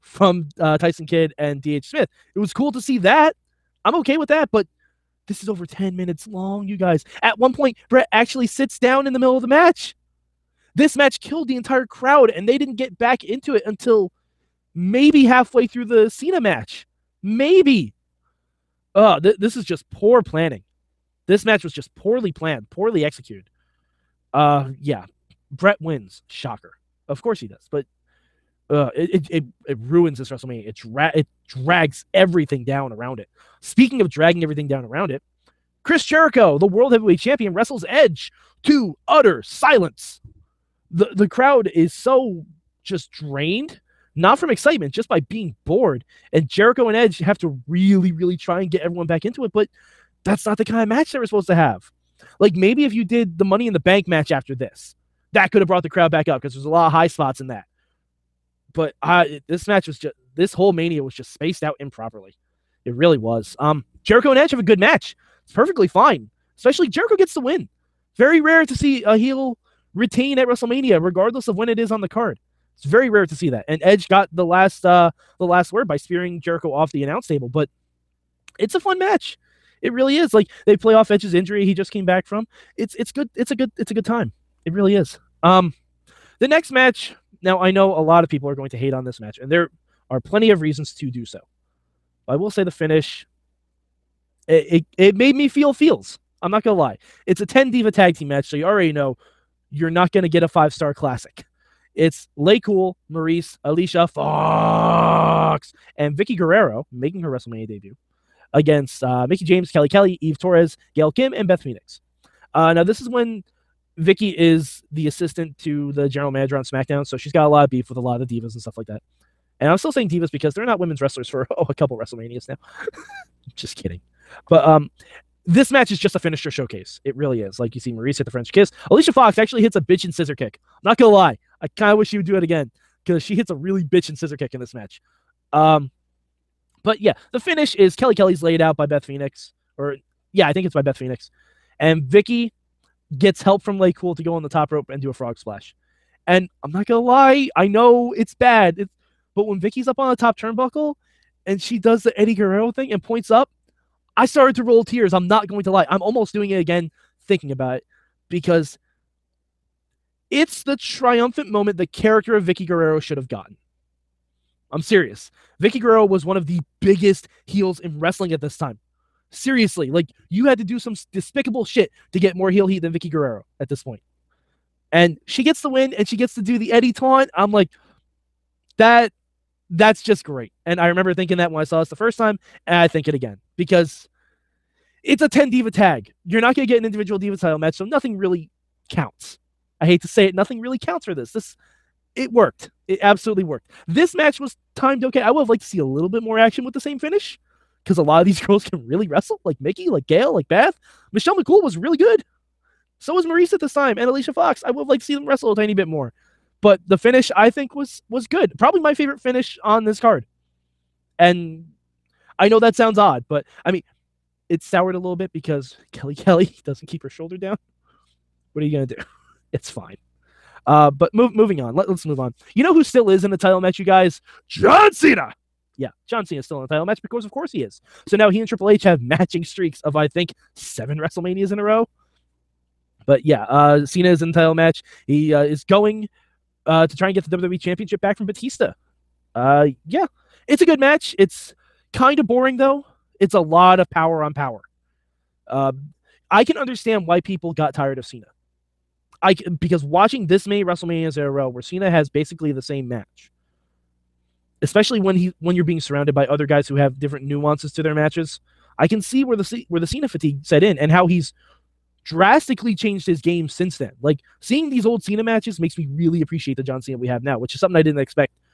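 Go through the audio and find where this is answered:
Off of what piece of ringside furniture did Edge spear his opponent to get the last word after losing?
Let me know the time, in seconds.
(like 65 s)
76 s.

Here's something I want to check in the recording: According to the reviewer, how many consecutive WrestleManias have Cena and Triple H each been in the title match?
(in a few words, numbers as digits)
7.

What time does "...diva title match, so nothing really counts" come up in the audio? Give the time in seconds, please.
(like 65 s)
187 s.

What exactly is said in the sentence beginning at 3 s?
I'm okay with that, but this is over 10 minutes long, you guys.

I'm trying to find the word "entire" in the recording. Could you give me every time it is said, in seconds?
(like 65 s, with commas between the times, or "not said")
11 s, 234 s.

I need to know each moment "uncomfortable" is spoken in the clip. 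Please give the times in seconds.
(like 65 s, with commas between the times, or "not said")
not said.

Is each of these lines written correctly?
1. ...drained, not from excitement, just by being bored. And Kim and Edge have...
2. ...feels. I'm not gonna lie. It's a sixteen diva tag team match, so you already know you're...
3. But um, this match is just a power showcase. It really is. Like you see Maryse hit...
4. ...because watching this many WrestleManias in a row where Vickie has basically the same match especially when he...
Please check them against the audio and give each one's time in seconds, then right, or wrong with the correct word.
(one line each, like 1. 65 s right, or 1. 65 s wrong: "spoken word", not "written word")
1. 43 s wrong: "Jericho", not "Kim"
2. 95 s wrong: "ten", not "sixteen"
3. 124 s wrong: "finisher", not "power"
4. 249 s wrong: "Cena", not "Vickie".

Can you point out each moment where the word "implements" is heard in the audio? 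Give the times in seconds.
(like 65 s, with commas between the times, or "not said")
not said.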